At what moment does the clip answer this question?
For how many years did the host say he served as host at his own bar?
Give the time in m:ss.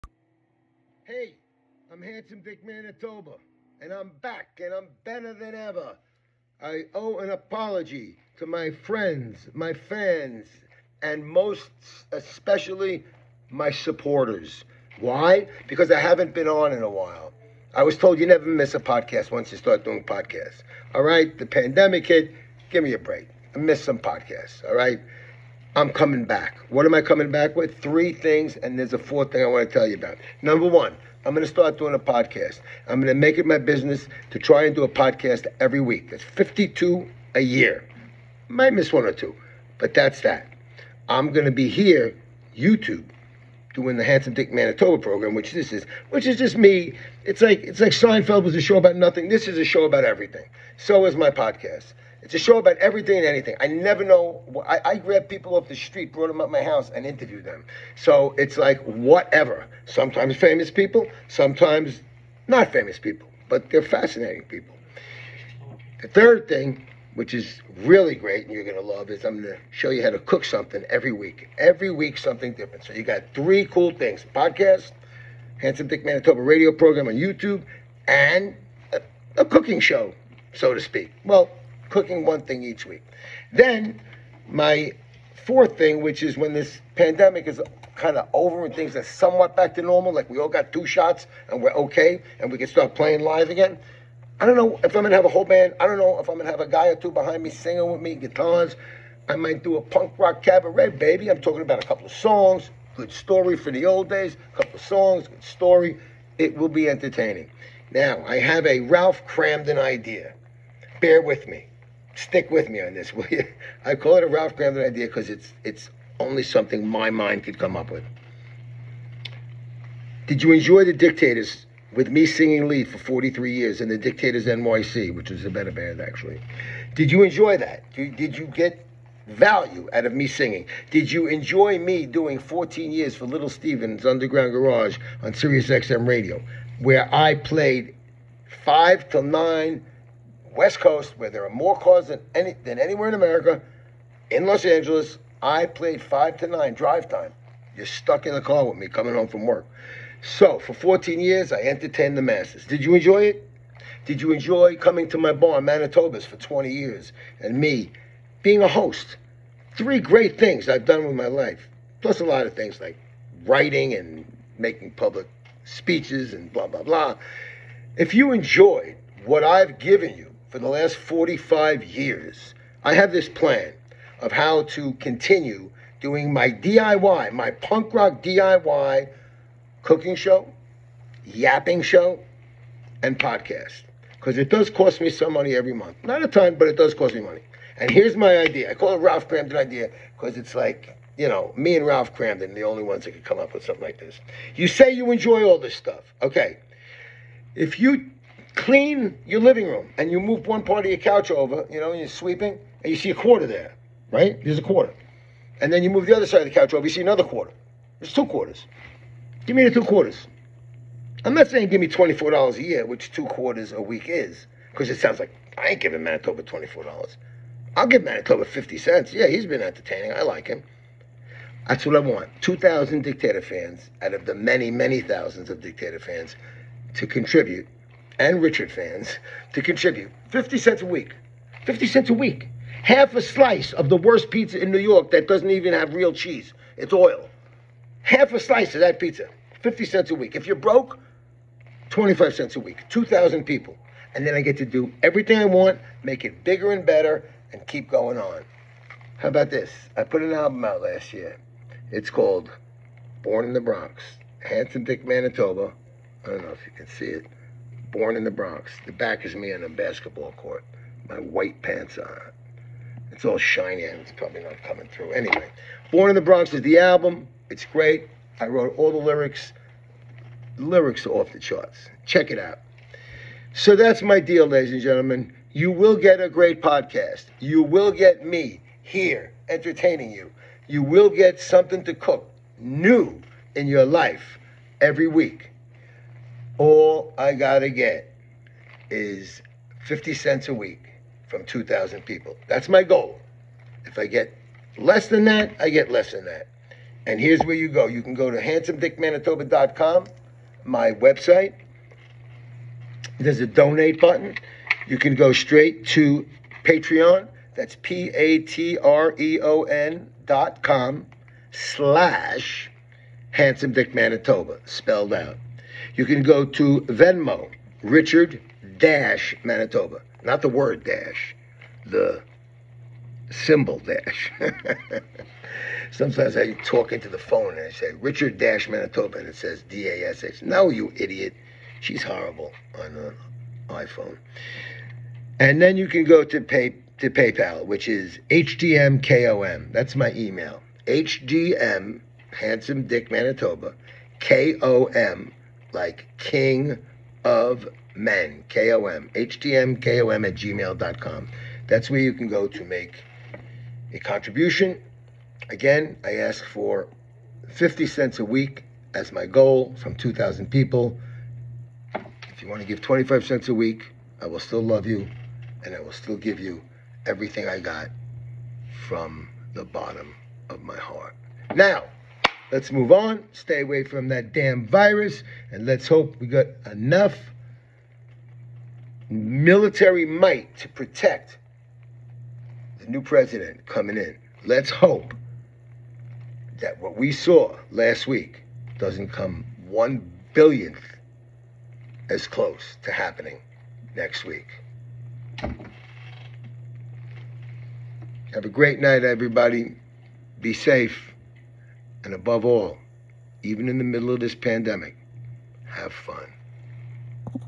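2:36.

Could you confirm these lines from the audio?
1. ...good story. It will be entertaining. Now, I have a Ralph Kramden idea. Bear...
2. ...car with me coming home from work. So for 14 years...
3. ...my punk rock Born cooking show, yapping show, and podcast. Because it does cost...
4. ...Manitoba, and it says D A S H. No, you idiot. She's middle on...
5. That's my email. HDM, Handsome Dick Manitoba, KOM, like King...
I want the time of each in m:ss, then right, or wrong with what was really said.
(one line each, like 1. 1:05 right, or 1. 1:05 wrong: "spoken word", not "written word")
1. 1:45 right
2. 2:28 right
3. 2:57 wrong: "DIY", not "Born"
4. 5:28 wrong: "horrible", not "middle"
5. 5:39 right.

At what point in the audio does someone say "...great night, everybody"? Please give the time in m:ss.
6:38.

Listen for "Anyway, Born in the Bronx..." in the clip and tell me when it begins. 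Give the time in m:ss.
4:25.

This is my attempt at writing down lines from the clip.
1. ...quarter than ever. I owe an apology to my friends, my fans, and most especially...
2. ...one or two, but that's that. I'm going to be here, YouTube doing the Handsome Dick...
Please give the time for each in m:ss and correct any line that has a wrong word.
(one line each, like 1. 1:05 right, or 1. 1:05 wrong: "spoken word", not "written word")
1. 0:05 wrong: "better", not "quarter"
2. 0:38 right.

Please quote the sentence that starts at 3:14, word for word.
You say you enjoy all this stuff.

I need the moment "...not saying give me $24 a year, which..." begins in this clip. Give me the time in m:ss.
3:31.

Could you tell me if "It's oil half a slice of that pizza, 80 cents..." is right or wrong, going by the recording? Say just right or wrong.
wrong.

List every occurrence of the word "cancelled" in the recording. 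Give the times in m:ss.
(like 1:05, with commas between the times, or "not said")
not said.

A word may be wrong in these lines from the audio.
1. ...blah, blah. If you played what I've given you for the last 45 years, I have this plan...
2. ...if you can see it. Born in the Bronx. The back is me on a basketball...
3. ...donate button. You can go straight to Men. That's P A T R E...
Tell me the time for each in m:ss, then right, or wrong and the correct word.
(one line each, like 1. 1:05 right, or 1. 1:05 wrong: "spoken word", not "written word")
1. 2:46 wrong: "enjoyed", not "played"
2. 4:16 right
3. 5:03 wrong: "Patreon", not "Men".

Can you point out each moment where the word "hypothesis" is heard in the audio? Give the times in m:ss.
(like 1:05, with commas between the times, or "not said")
not said.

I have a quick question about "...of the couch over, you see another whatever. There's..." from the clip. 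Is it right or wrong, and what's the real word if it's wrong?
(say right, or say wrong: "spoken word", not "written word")
wrong: "quarter", not "whatever".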